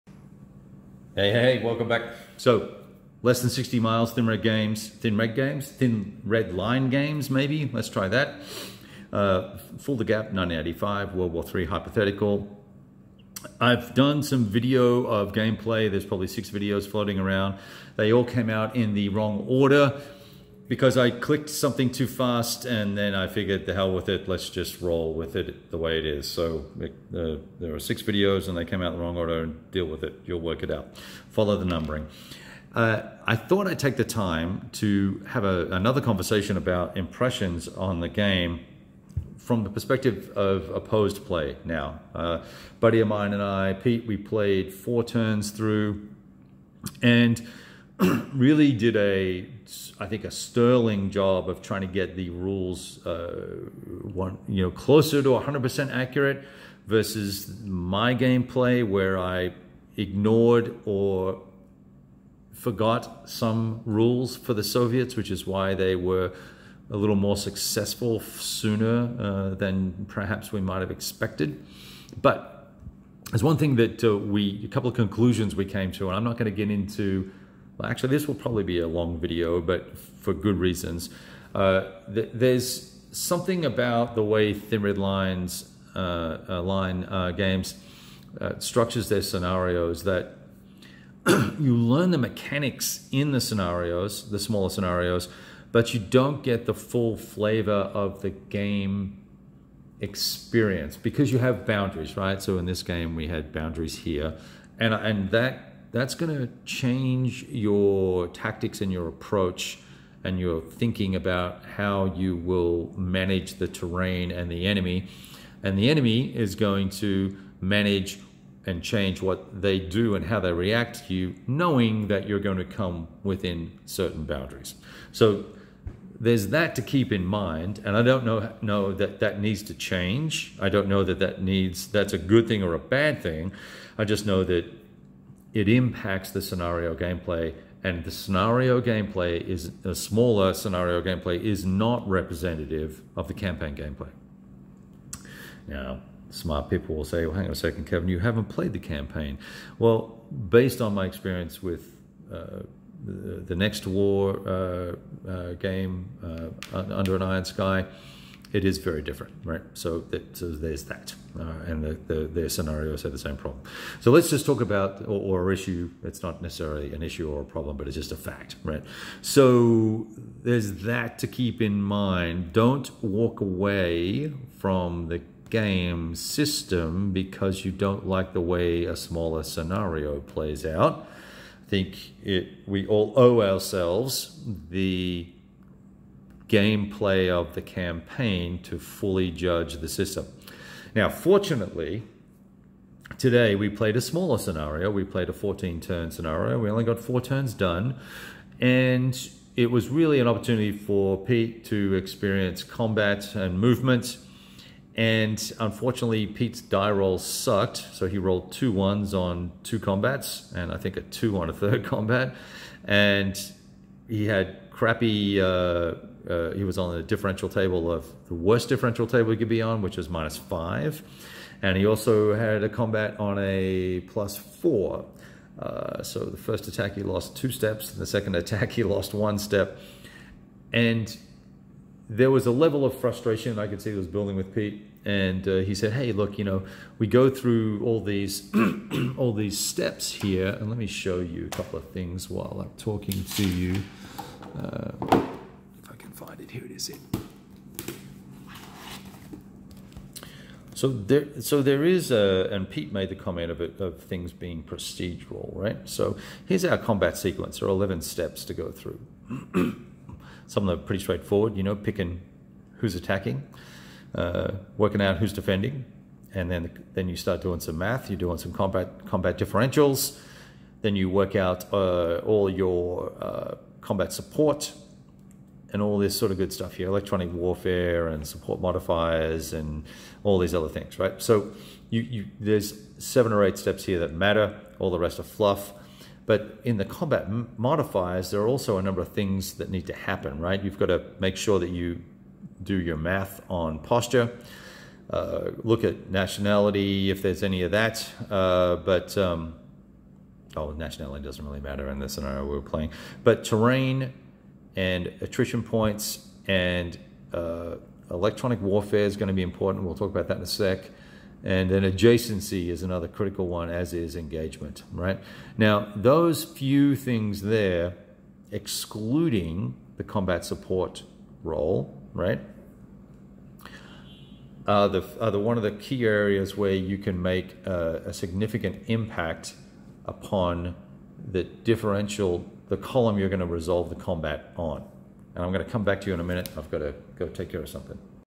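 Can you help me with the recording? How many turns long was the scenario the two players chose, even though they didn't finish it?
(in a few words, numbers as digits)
14.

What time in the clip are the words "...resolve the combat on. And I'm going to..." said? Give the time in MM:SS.
05:33.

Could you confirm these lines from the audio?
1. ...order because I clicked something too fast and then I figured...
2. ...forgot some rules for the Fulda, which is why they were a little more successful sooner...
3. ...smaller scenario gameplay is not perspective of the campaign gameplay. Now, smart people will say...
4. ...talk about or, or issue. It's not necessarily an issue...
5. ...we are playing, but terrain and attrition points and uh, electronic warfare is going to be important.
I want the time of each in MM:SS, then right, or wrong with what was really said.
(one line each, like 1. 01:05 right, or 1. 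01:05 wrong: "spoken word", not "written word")
1. 00:19 right
2. 01:02 wrong: "Soviets", not "Fulda"
3. 02:19 wrong: "representative", not "perspective"
4. 02:44 right
5. 05:02 right.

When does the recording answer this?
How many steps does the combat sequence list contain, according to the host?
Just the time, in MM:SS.
04:17.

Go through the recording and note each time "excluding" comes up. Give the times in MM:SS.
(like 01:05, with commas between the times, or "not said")
05:18.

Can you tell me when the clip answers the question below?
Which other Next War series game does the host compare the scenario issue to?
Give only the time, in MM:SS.
02:36.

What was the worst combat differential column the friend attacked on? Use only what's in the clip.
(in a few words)
-5.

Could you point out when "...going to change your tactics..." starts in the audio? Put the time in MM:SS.
01:46.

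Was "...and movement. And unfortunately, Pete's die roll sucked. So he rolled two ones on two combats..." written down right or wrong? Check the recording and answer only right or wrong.
right.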